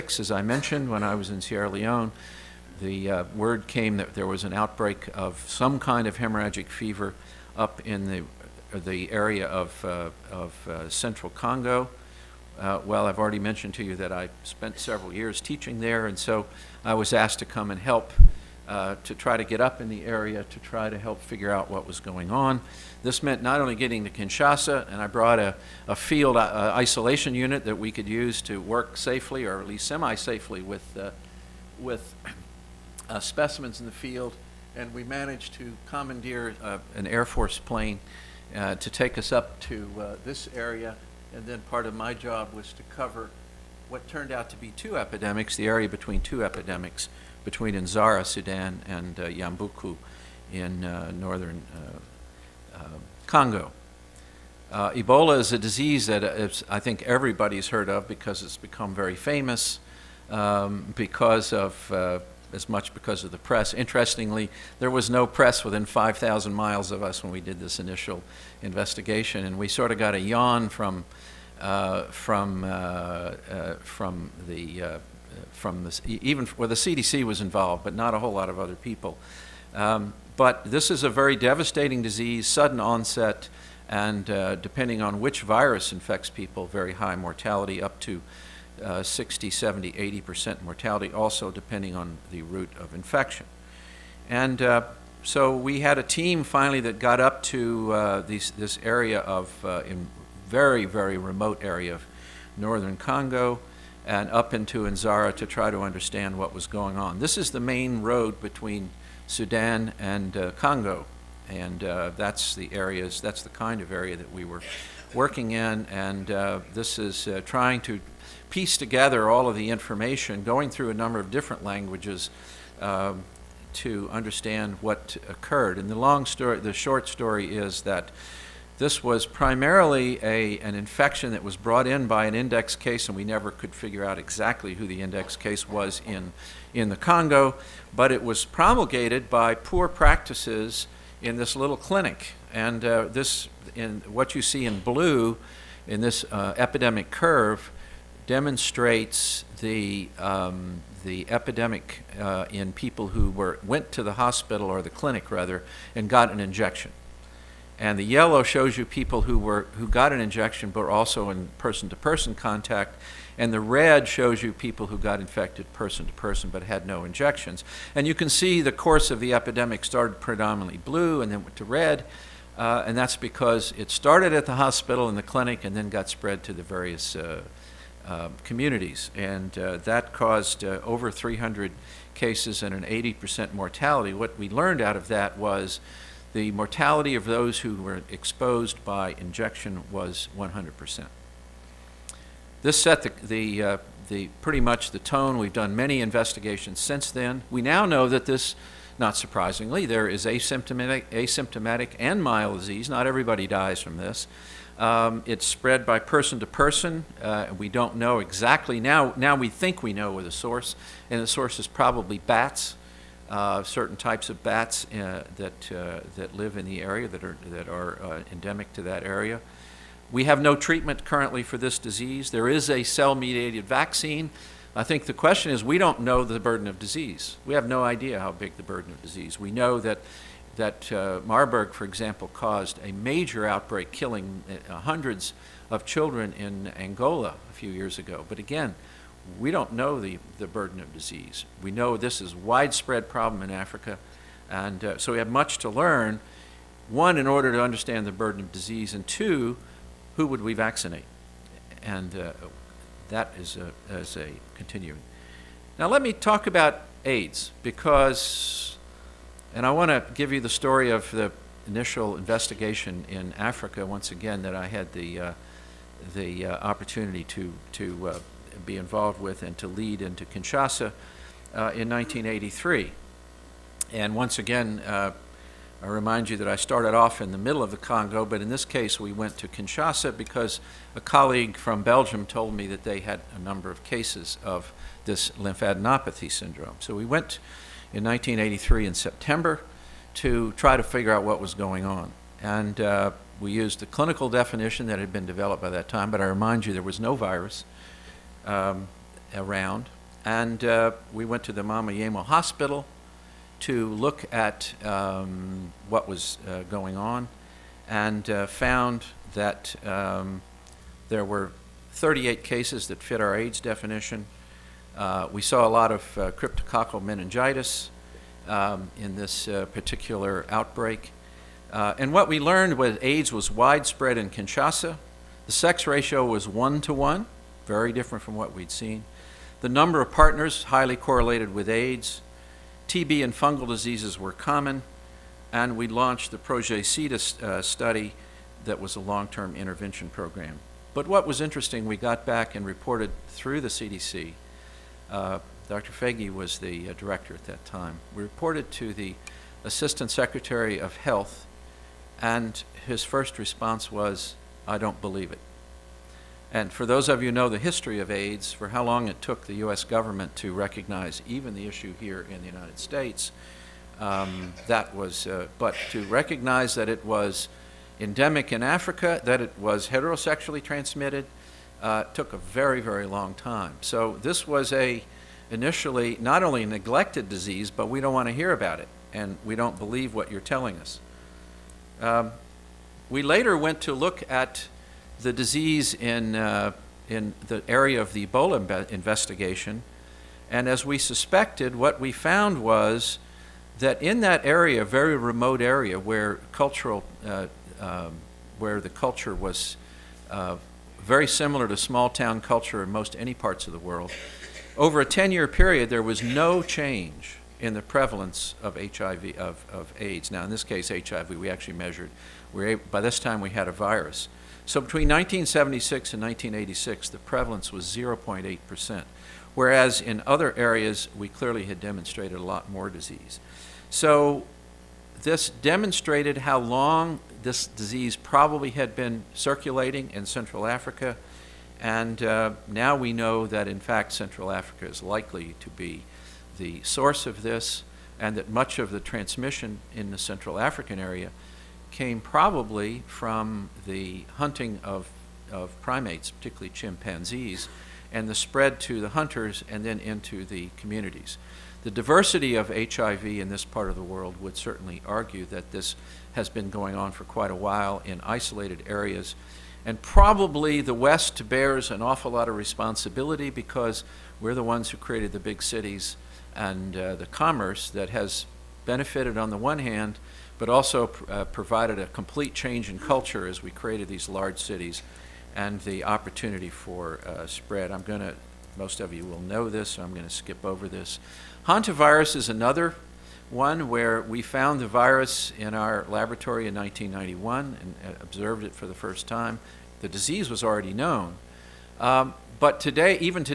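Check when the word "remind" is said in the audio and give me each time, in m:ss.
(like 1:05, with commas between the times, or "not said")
4:35, 4:56.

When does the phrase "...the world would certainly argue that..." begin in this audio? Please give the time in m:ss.
7:33.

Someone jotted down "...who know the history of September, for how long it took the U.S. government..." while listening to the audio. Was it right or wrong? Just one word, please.
wrong.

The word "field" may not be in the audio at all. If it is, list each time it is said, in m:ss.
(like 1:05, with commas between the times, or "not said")
0:25, 0:33.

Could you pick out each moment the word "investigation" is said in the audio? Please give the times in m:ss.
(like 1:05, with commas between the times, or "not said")
1:08, 3:16, 4:22, 6:28.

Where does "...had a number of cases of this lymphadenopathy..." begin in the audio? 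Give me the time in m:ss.
4:42.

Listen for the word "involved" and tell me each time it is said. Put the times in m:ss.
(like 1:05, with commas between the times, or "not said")
1:17, 4:28.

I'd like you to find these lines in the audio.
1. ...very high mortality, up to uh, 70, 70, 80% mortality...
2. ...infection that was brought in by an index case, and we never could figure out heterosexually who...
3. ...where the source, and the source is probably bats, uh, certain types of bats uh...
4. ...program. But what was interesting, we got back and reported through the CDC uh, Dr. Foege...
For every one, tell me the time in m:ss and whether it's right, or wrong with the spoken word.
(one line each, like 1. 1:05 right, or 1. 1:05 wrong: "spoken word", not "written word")
1. 1:26 wrong: "60", not "70"
2. 2:10 wrong: "exactly", not "heterosexually"
3. 3:30 right
4. 5:40 right.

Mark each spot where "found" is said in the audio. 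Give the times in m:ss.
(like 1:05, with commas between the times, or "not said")
5:08, 6:32, 8:04.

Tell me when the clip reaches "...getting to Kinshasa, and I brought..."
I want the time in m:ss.
0:23.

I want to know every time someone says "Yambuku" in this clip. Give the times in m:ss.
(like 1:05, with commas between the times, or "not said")
0:49.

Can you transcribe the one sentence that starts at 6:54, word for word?
So between 1976 and 1986, the prevalence was 0.8%, whereas in other areas, we clearly had demonstrated a lot more disease.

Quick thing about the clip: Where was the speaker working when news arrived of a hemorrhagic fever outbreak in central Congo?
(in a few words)
Sierra Leone.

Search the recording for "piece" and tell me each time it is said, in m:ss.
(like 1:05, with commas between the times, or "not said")
1:58.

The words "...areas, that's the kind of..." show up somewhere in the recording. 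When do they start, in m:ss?
1:52.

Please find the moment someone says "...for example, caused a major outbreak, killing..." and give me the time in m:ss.
3:51.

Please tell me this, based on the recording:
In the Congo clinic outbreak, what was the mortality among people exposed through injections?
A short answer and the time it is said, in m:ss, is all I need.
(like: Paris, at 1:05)
100%, at 3:10.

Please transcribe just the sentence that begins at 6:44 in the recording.
Over a 10 year period, there was no change in the prevalence of HIV, of, of AIDS.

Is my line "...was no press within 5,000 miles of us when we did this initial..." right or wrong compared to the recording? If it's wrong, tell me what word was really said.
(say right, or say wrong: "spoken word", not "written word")
right.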